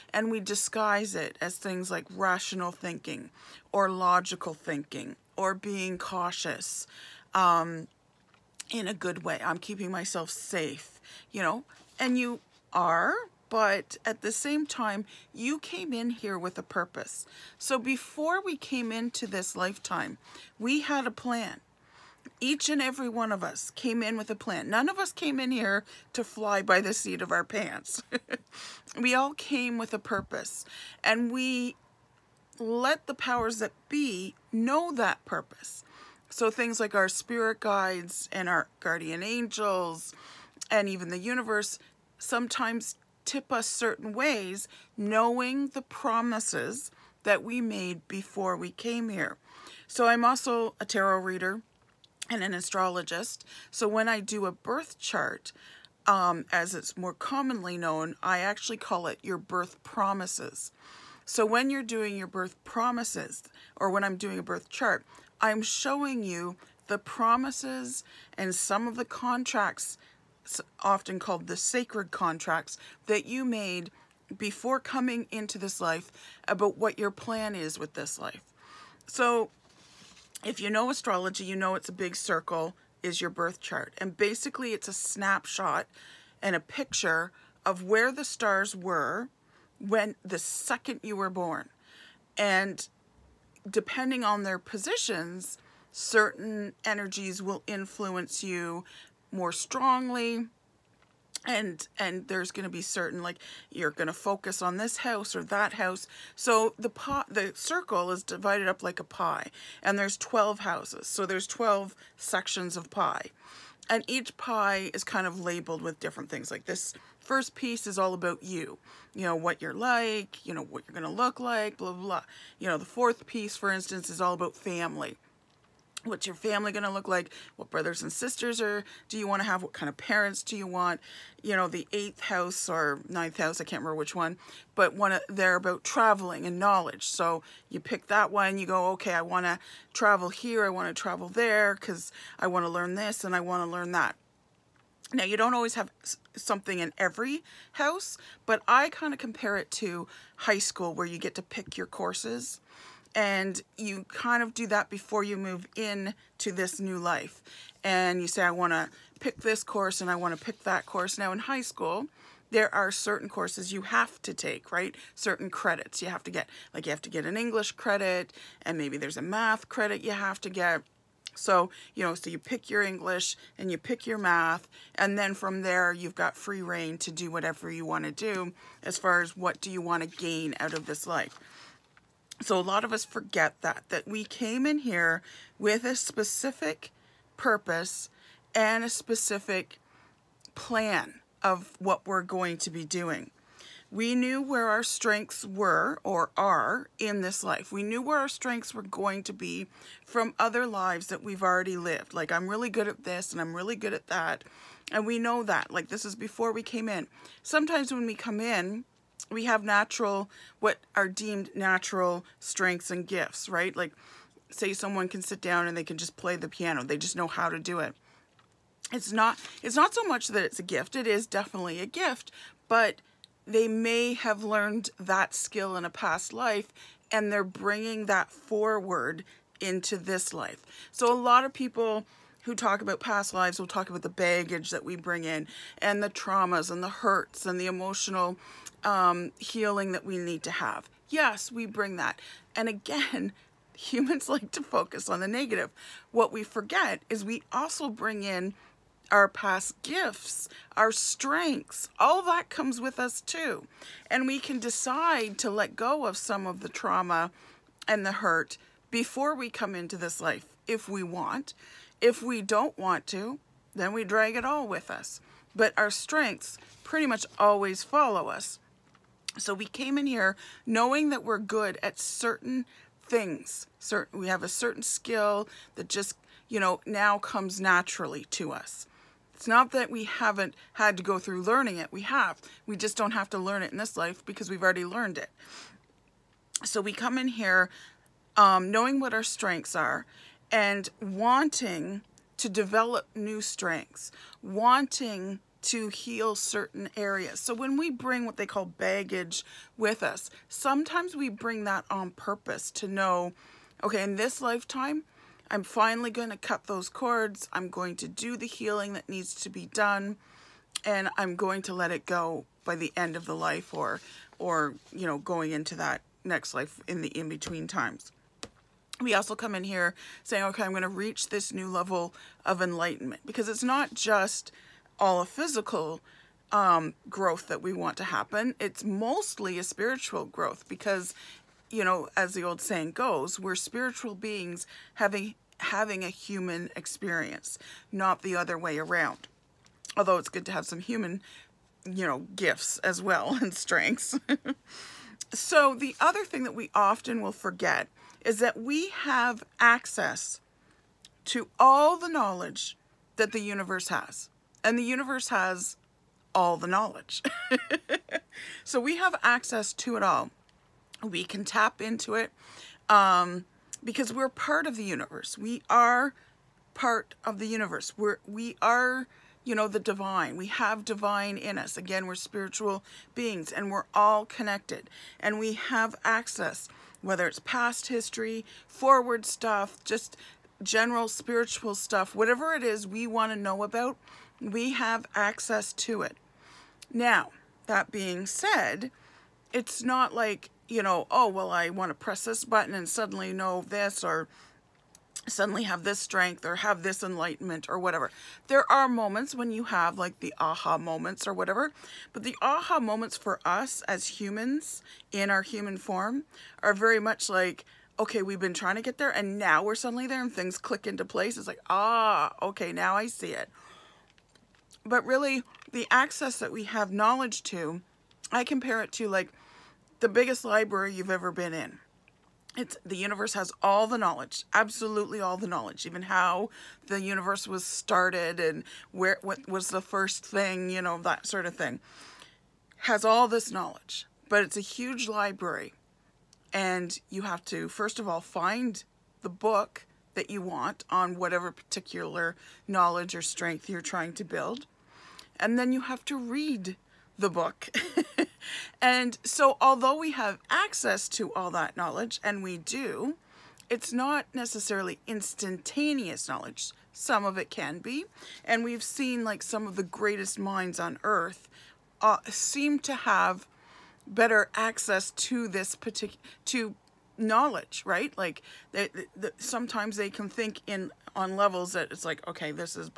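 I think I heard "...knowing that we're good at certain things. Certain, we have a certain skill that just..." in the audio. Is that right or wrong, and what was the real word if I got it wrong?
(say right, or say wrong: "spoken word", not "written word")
right.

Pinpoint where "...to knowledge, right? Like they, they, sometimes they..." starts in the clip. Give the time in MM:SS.
07:46.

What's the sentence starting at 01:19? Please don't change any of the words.
So if you know astrology, you know it's a big circle is your birth chart.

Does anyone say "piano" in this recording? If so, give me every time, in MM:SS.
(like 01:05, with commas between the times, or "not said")
03:36.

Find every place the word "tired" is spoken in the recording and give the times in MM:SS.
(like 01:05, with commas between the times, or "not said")
not said.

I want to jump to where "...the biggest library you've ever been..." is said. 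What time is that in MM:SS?
07:00.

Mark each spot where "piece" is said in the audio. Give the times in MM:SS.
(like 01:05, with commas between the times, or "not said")
01:57, 02:03.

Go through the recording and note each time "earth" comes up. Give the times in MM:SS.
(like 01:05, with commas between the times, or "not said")
07:41.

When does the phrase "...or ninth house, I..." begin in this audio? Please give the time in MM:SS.
02:12.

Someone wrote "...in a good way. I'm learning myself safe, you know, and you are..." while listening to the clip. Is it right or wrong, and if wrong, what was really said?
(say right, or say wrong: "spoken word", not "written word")
wrong: "keeping", not "learning".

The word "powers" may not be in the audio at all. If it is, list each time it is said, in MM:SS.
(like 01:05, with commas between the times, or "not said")
00:33.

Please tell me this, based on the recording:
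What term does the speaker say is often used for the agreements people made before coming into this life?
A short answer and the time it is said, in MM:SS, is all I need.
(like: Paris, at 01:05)
sacred contracts, at 01:11.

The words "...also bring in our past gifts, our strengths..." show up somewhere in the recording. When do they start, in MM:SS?
04:07.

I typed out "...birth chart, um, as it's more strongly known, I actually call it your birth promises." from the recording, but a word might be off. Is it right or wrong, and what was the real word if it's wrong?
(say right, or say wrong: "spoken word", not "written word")
wrong: "commonly", not "strongly".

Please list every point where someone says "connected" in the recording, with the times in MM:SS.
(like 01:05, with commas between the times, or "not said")
06:14.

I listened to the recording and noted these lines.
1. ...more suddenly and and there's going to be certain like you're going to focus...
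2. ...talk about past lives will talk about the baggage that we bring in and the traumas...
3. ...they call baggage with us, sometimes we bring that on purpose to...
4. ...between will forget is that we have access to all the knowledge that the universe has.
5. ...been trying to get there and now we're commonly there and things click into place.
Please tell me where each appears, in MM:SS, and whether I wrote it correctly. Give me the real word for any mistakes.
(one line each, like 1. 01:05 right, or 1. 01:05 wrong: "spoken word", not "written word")
1. 01:39 wrong: "strongly", not "suddenly"
2. 03:52 right
3. 04:58 right
4. 05:46 wrong: "often", not "between"
5. 06:48 wrong: "suddenly", not "commonly".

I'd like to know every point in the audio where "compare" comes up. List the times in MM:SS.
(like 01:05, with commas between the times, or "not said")
02:29, 06:58.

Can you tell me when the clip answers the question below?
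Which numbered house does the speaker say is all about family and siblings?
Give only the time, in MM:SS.
02:02.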